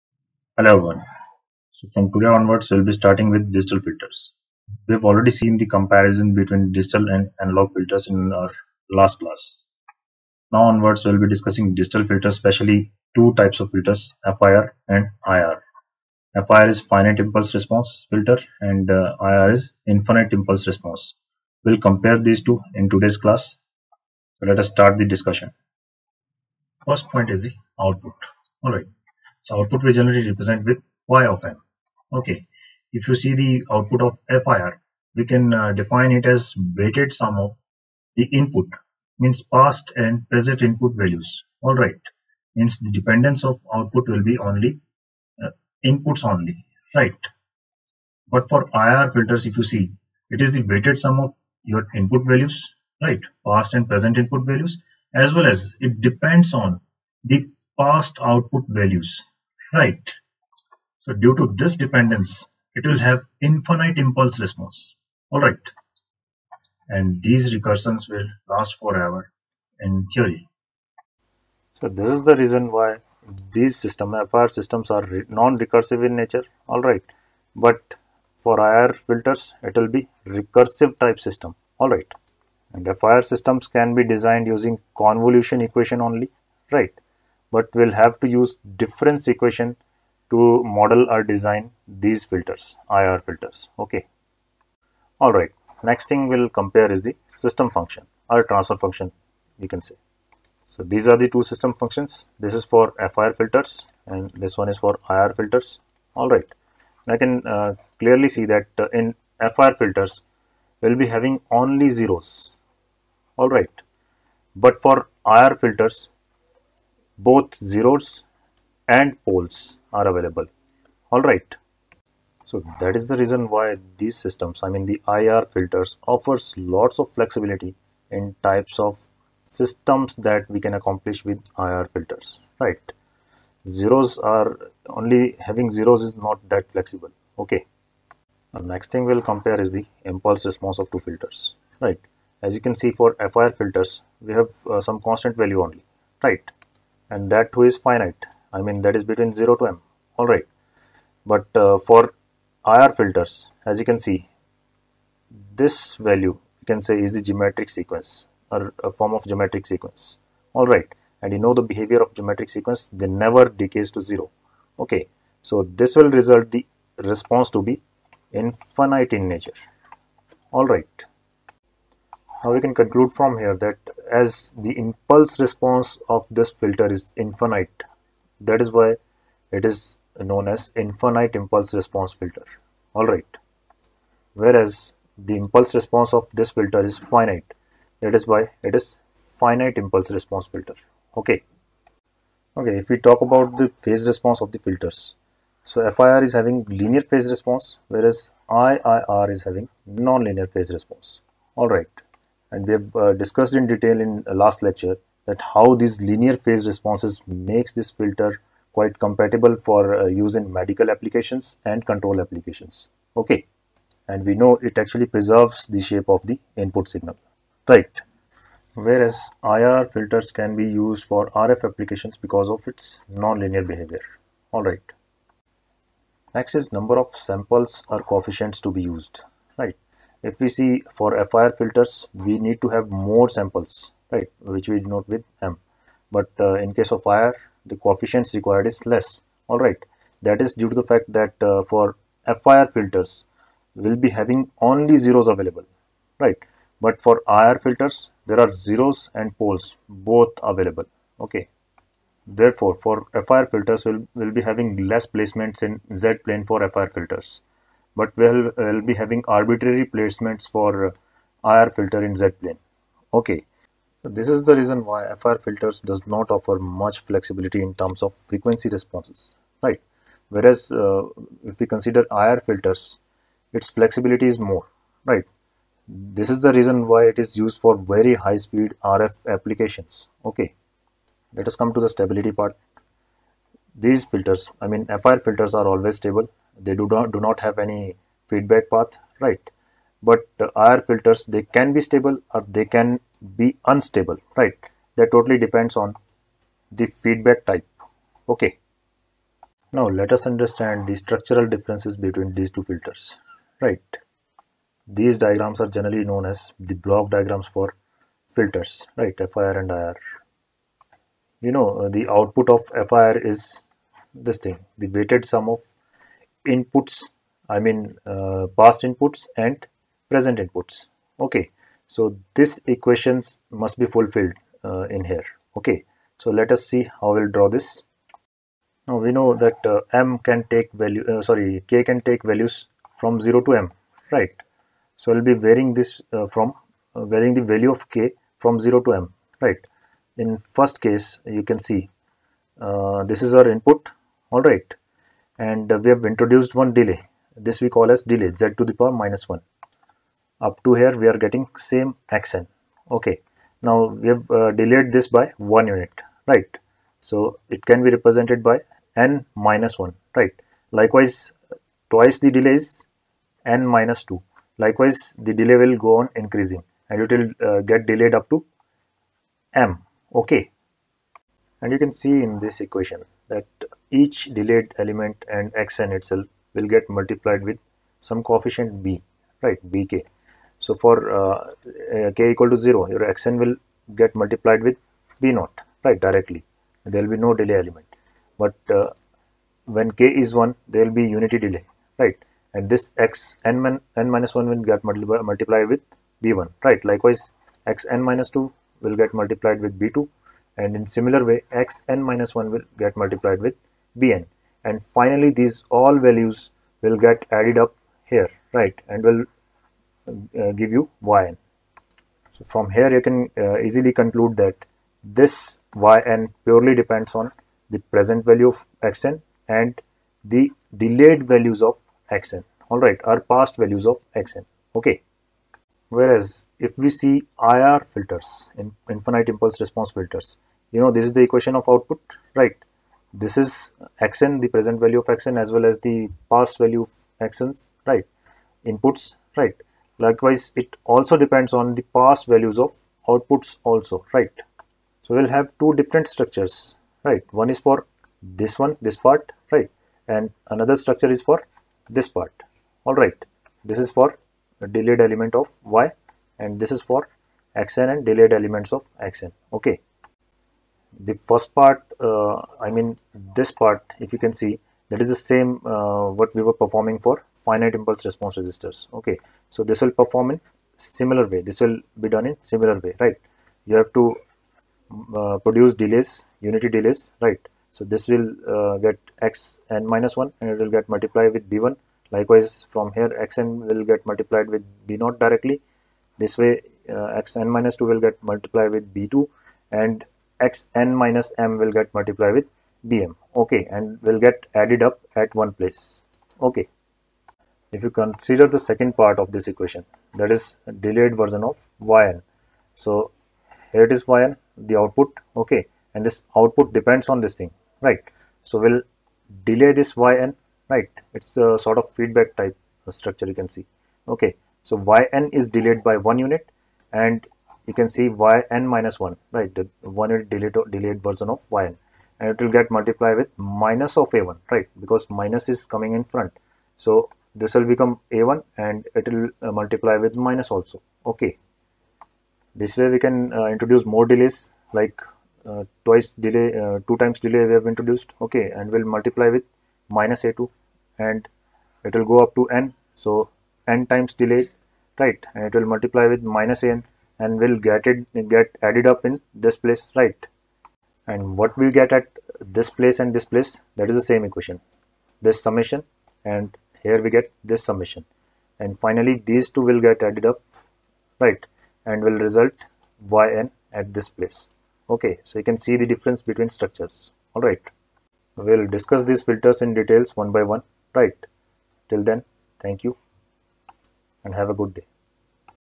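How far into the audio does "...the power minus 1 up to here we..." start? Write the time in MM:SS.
05:48.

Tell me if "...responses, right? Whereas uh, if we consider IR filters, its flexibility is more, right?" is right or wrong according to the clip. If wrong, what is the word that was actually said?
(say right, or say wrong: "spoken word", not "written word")
right.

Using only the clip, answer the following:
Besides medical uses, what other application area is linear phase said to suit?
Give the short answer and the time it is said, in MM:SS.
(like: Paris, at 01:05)
Control applications, at 03:31.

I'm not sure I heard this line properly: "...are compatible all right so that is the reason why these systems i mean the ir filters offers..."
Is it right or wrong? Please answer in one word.
wrong.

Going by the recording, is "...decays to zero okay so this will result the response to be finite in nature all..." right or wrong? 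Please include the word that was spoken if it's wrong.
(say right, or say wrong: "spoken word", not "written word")
wrong: "infinite", not "finite".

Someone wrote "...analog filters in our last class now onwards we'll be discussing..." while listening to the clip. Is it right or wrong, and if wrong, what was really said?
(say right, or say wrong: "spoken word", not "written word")
right.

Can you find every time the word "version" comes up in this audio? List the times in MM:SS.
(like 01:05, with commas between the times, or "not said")
08:21, 08:41.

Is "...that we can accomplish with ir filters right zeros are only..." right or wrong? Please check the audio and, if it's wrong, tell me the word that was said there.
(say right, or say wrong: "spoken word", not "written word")
right.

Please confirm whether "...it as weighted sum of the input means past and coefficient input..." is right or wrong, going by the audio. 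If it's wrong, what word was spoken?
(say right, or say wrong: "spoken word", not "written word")
wrong: "present", not "coefficient".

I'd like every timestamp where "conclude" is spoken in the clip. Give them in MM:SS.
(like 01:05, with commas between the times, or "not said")
02:52, 06:53.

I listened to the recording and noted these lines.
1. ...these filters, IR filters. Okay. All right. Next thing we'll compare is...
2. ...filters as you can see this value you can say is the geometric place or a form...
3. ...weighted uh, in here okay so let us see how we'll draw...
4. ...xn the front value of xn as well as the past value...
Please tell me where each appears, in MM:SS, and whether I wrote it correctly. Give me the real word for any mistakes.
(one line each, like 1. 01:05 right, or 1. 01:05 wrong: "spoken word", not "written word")
1. 01:31 right
2. 02:32 wrong: "sequence", not "place"
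3. 05:23 wrong: "fulfilled", not "weighted"
4. 07:14 wrong: "present", not "front".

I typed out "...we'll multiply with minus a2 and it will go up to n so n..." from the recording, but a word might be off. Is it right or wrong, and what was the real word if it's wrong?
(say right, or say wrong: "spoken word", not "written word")
right.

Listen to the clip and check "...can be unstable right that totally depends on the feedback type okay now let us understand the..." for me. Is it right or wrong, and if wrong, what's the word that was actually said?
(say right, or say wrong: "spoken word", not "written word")
right.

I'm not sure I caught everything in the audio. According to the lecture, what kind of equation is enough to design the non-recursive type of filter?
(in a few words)
Convolution equation.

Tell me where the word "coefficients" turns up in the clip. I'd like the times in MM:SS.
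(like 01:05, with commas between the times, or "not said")
03:48, 03:57, 06:18.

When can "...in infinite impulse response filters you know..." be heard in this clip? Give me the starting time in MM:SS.
07:08.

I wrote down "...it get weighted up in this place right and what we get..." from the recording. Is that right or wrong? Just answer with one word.
wrong.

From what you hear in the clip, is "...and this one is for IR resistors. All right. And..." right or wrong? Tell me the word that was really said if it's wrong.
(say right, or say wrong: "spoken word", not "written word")
wrong: "filters", not "resistors".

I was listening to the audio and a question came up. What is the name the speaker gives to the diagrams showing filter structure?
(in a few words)
Block diagrams.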